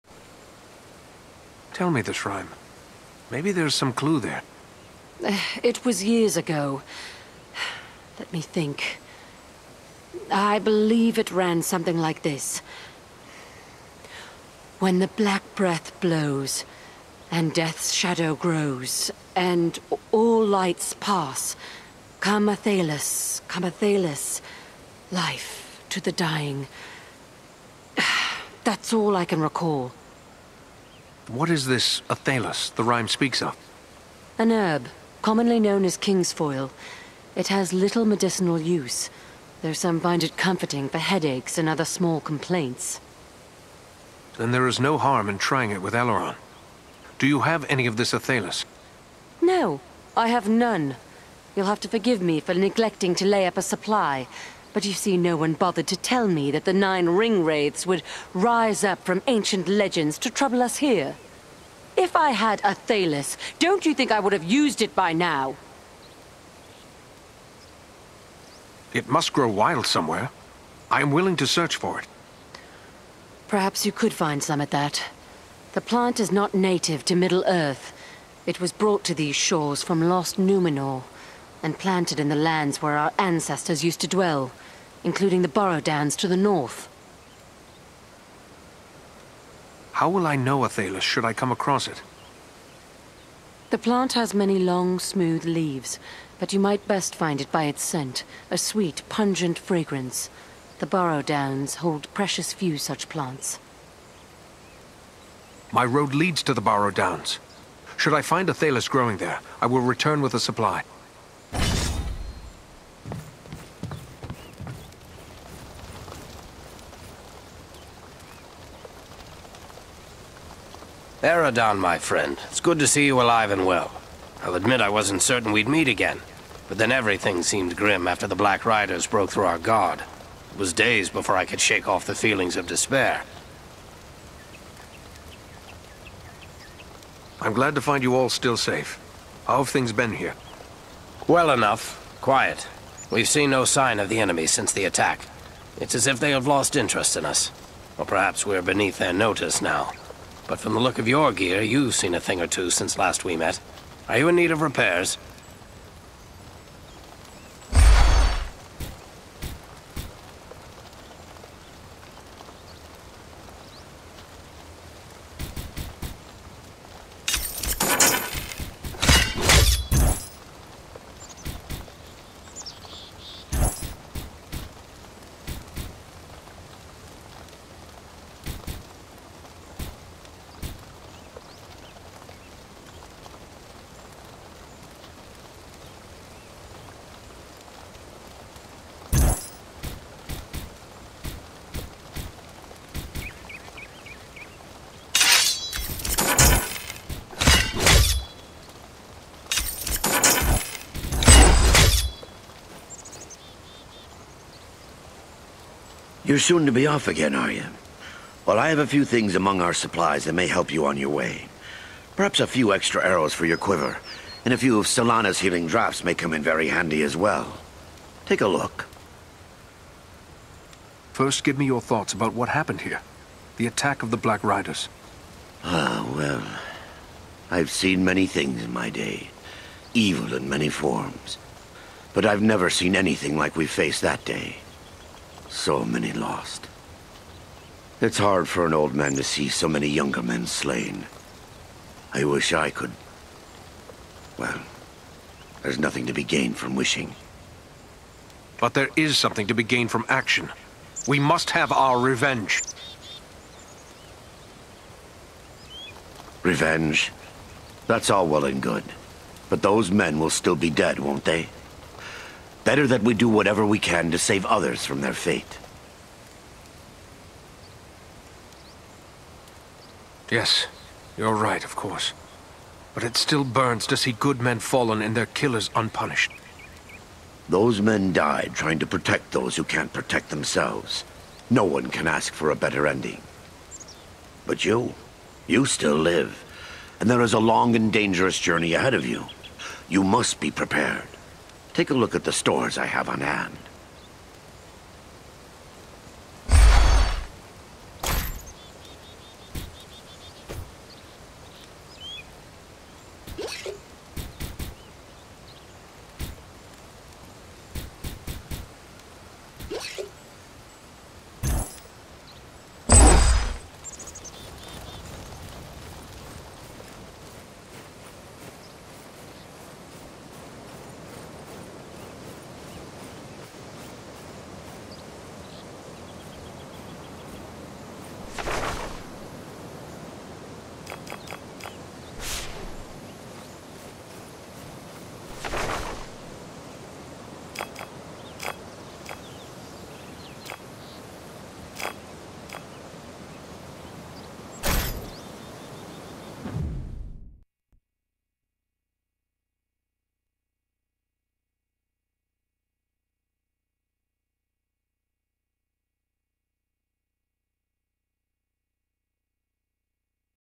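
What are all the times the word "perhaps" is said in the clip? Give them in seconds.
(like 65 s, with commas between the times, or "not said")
73 s, 148 s, 212 s.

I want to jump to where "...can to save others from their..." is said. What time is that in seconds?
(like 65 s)
263 s.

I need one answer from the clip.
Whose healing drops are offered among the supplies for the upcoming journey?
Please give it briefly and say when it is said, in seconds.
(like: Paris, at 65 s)
Solana's, at 214 s.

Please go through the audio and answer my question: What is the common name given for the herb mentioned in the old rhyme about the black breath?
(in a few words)
king's foil.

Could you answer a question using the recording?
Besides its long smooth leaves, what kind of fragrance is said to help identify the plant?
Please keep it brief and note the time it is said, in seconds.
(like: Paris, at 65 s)
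sweet, pungent, at 98 s.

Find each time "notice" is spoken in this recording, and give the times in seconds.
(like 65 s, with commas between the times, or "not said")
149 s.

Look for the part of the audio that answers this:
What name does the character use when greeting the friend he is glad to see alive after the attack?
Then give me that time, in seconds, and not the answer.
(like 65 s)
121 s.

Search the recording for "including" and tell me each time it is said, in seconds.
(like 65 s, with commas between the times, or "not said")
85 s.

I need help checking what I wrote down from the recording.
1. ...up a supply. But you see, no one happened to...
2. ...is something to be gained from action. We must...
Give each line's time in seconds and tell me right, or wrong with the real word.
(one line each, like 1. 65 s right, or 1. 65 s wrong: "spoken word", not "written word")
1. 53 s wrong: "bothered", not "happened"
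2. 248 s right.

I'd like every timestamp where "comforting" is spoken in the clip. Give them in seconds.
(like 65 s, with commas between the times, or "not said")
40 s.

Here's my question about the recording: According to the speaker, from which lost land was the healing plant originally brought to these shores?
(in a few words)
Numenor.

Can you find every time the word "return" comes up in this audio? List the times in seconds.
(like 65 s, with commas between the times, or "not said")
109 s.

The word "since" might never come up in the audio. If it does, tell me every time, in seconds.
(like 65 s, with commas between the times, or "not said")
144 s, 152 s.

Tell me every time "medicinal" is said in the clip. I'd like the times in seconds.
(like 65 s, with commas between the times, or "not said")
38 s.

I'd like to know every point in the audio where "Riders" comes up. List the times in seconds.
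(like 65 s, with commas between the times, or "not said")
128 s, 224 s.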